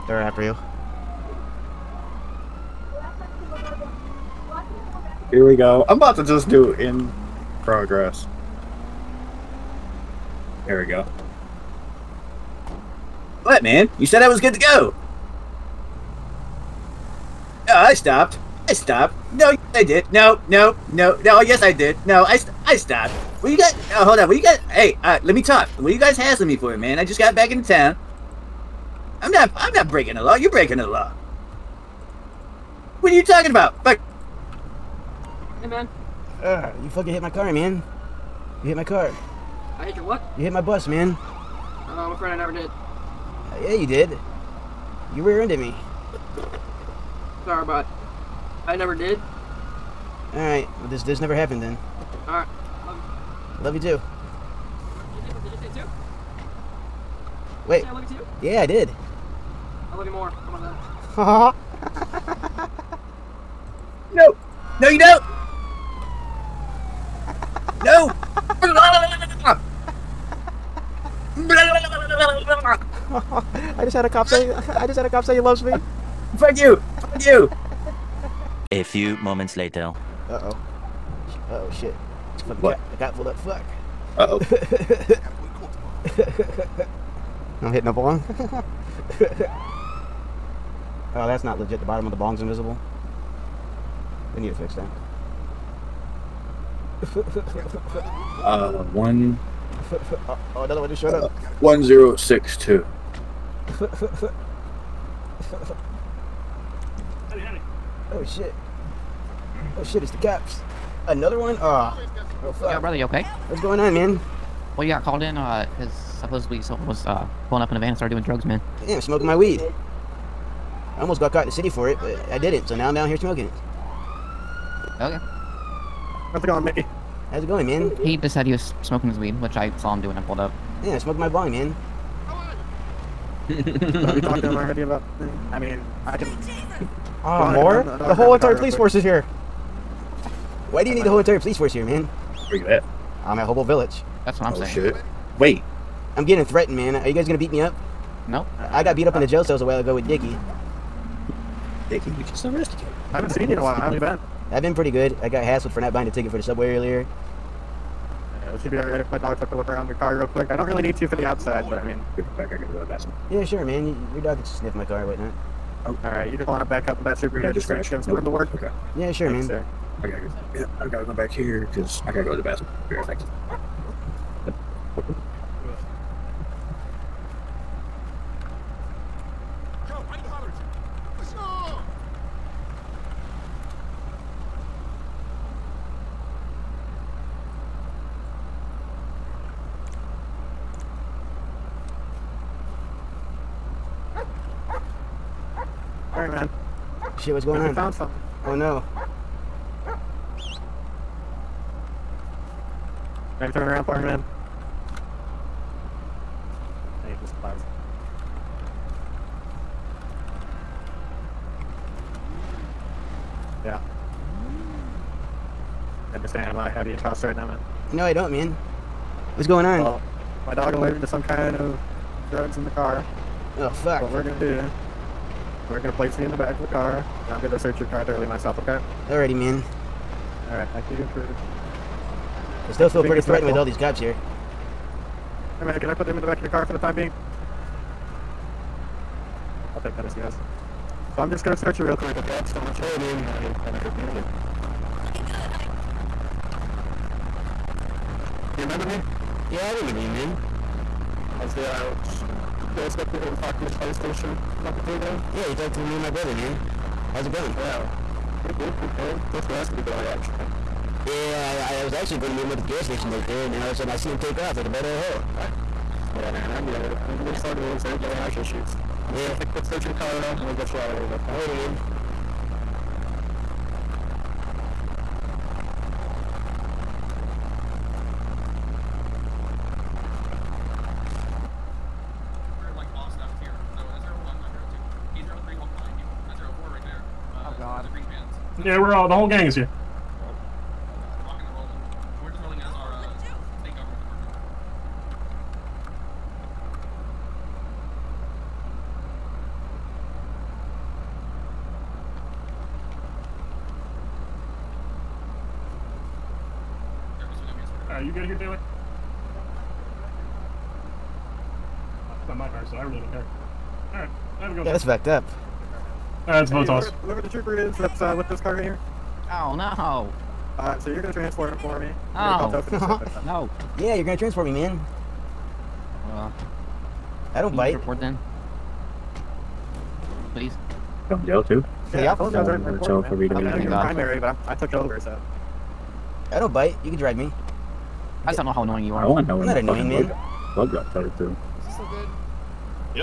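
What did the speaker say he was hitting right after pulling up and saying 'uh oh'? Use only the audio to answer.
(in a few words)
A bong.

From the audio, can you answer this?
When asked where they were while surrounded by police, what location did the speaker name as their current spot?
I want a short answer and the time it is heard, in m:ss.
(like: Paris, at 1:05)
Hobo Village, at 2:23.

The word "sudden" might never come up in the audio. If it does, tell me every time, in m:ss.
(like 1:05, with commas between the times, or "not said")
4:23.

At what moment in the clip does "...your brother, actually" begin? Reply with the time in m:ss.
4:19.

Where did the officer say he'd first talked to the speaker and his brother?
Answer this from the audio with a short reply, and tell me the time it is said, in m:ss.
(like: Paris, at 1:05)
The fire station, at 4:13.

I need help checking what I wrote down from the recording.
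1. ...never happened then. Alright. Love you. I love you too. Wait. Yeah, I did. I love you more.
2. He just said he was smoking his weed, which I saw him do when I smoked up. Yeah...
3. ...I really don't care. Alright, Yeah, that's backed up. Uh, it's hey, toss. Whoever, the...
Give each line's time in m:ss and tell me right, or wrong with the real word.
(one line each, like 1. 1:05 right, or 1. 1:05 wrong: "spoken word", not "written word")
1. 0:51 right
2. 2:08 wrong: "pulled", not "smoked"
3. 5:12 right.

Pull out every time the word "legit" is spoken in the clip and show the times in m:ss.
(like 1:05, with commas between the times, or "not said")
1:31.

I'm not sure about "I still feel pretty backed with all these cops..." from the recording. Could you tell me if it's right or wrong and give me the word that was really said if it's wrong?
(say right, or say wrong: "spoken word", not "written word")
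wrong: "threatened", not "backed".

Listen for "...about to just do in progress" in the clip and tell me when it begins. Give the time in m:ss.
0:05.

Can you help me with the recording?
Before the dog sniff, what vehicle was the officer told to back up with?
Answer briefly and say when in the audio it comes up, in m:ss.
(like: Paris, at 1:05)
Subaru, at 2:47.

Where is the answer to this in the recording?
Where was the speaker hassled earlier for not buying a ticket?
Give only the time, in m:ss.
2:36.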